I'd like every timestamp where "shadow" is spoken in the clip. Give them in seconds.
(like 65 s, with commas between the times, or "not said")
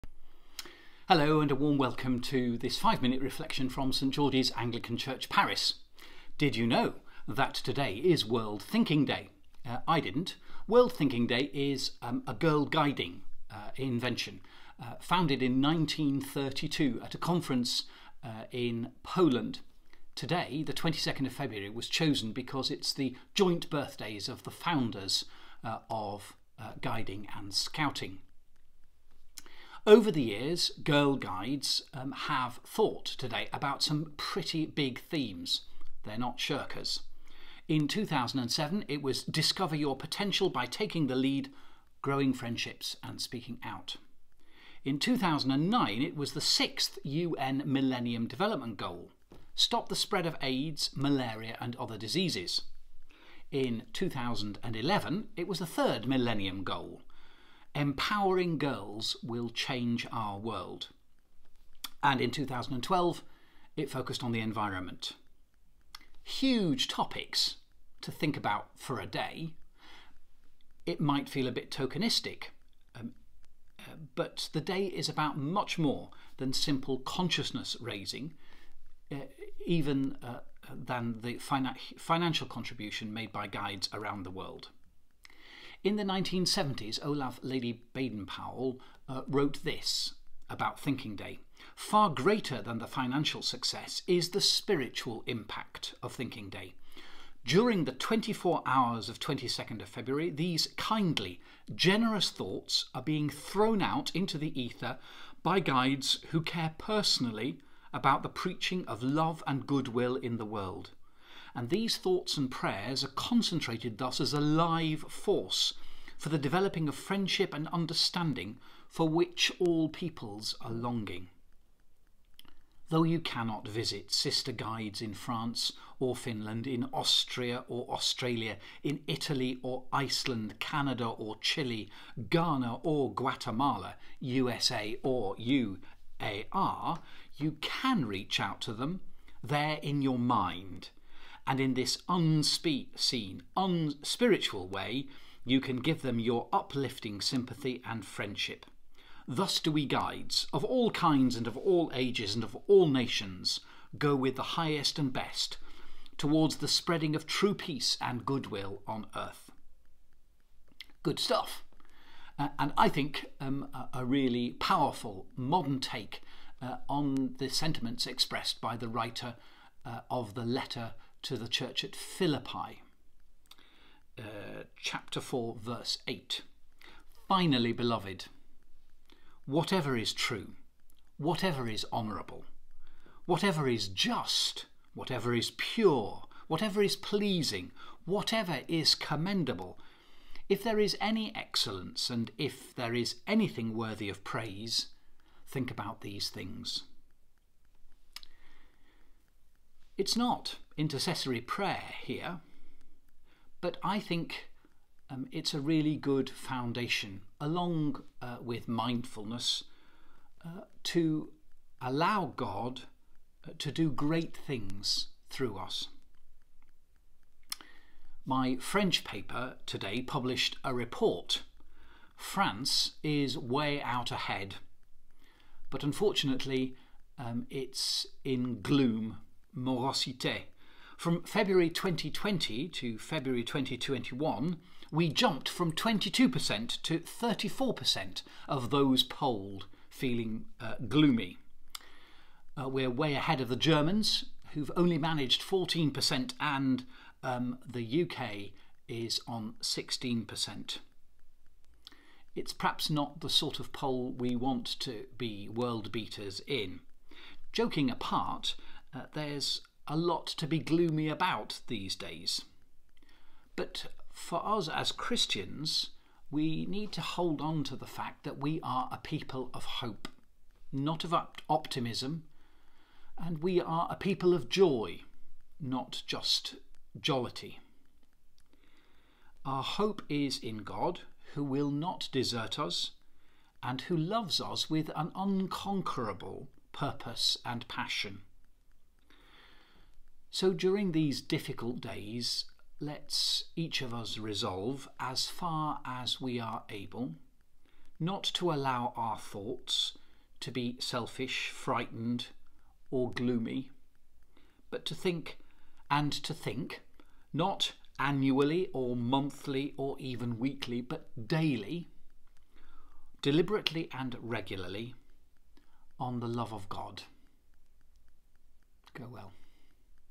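not said.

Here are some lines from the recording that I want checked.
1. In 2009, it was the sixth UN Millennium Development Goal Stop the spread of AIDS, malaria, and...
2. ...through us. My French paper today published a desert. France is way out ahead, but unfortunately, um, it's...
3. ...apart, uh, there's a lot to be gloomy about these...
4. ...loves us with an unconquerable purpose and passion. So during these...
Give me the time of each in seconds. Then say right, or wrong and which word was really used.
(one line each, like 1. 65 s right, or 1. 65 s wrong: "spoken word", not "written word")
1. 44 s right
2. 215 s wrong: "report", not "desert"
3. 257 s right
4. 283 s right.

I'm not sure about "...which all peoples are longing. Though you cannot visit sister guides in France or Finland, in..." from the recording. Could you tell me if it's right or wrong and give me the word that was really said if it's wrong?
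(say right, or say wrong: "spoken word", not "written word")
right.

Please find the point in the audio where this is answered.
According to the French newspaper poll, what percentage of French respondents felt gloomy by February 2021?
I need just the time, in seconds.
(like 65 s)
236 s.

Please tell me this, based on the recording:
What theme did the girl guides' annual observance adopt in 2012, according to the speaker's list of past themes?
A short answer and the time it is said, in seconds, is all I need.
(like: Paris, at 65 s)
The environment, at 64 s.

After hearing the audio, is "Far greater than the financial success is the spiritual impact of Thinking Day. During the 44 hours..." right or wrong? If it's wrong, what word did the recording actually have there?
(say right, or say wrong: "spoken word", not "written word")
wrong: "24", not "44".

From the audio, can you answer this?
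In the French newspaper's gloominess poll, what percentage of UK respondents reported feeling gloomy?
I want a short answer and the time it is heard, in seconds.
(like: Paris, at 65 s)
16%, at 249 s.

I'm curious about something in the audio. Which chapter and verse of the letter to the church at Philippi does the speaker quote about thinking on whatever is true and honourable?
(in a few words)
Chapter 4, verse 8.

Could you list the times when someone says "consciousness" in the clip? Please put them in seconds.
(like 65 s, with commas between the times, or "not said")
76 s.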